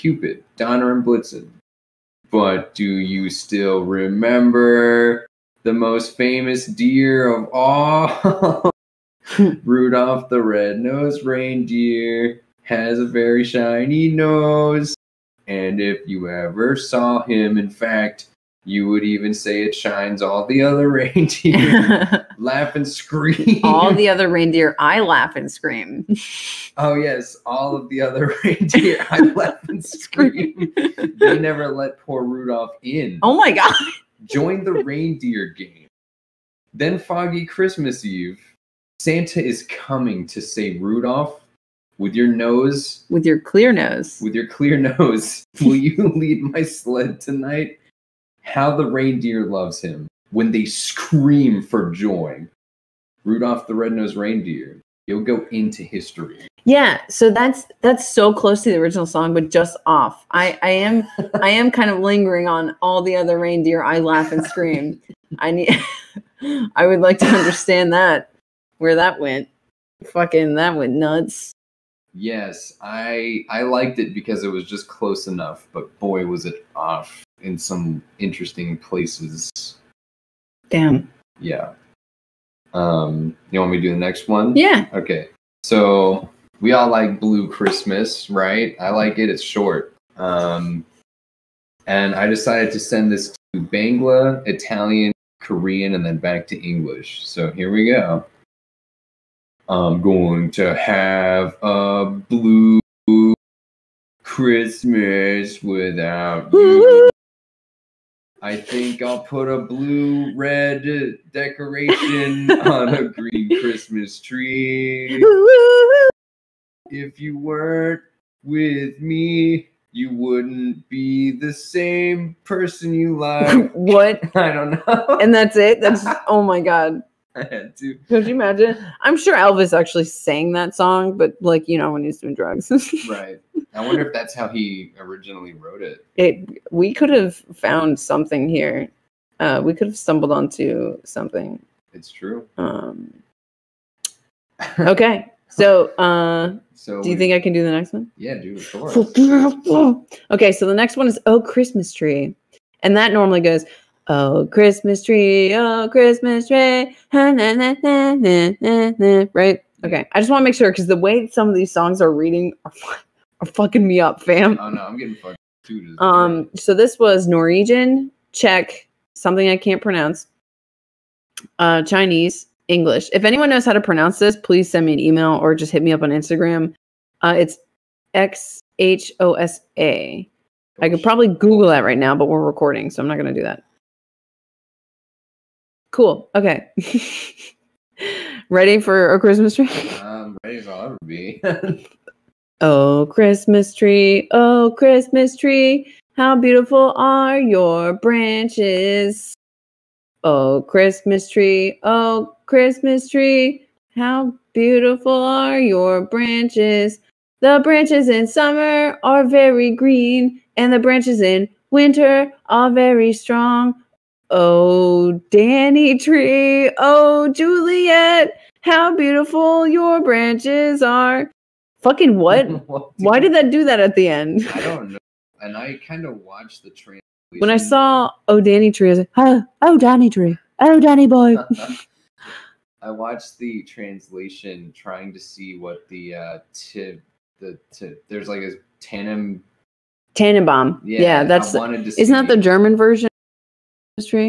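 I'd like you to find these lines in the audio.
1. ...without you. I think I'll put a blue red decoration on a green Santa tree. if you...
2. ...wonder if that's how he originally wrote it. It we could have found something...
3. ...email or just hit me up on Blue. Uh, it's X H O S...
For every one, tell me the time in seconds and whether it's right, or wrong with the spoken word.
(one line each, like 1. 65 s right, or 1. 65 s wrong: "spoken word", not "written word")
1. 105 s wrong: "Christmas", not "Santa"
2. 133 s right
3. 174 s wrong: "Instagram", not "Blue".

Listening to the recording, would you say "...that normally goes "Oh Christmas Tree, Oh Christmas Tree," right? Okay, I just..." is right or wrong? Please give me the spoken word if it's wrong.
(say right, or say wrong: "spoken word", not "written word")
right.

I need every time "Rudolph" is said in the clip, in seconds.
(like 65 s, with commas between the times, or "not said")
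9 s, 32 s, 40 s, 53 s.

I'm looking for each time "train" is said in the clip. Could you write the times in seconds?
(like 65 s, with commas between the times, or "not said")
226 s.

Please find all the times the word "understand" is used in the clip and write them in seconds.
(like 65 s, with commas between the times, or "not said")
67 s.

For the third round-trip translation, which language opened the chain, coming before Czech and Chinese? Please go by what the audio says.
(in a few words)
Norwegian.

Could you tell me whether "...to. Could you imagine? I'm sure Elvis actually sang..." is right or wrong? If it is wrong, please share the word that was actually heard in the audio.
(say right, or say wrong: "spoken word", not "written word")
right.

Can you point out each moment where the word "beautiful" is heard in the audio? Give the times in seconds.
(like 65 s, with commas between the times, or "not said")
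196 s, 204 s, 218 s.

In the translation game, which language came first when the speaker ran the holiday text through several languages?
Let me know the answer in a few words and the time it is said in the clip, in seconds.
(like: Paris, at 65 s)
Bangla, at 93 s.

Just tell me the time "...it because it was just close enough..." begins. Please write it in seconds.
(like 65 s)
73 s.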